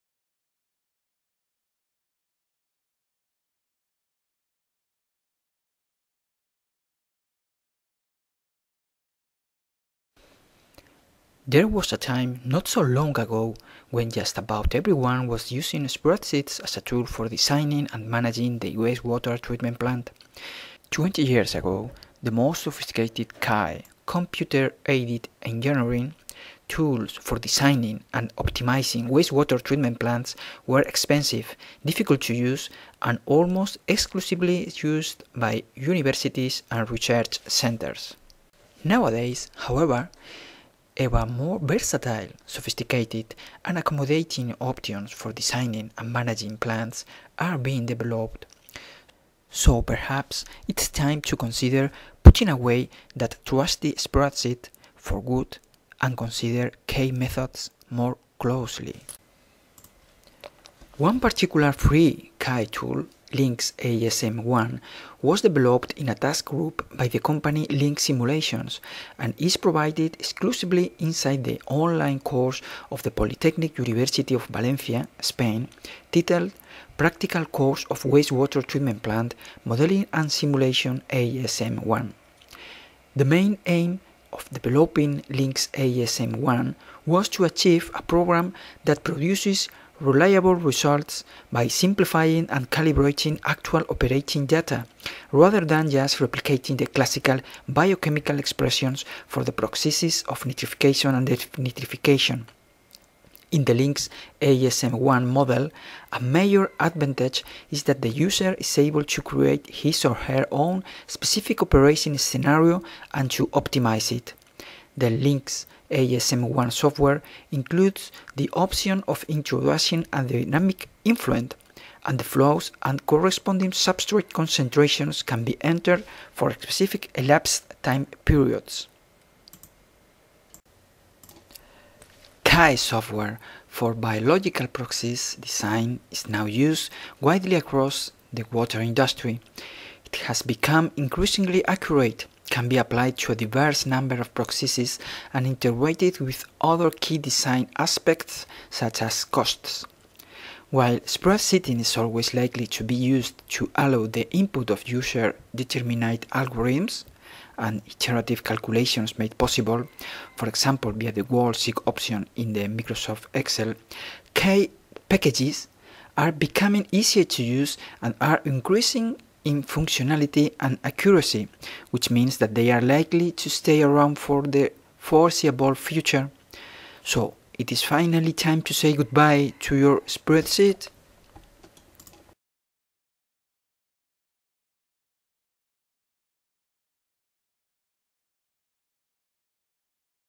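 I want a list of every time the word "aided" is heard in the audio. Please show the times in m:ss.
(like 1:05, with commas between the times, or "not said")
0:24.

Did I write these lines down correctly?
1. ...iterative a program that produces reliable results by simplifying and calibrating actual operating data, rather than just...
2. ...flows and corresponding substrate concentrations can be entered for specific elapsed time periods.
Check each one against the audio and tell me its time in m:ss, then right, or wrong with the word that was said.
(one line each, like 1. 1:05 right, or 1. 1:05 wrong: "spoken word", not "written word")
1. 1:27 wrong: "achieve", not "iterative"
2. 2:02 right.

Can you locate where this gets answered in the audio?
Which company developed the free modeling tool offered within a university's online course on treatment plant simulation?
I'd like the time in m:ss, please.
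1:07.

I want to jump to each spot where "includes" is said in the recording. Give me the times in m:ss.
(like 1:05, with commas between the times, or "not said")
1:57.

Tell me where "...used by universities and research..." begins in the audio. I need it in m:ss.
0:34.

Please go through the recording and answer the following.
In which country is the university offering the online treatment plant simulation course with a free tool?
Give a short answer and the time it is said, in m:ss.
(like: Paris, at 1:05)
Spain, at 1:15.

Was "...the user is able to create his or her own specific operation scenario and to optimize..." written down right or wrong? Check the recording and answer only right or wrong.
right.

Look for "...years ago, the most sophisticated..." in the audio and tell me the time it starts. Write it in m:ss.
0:21.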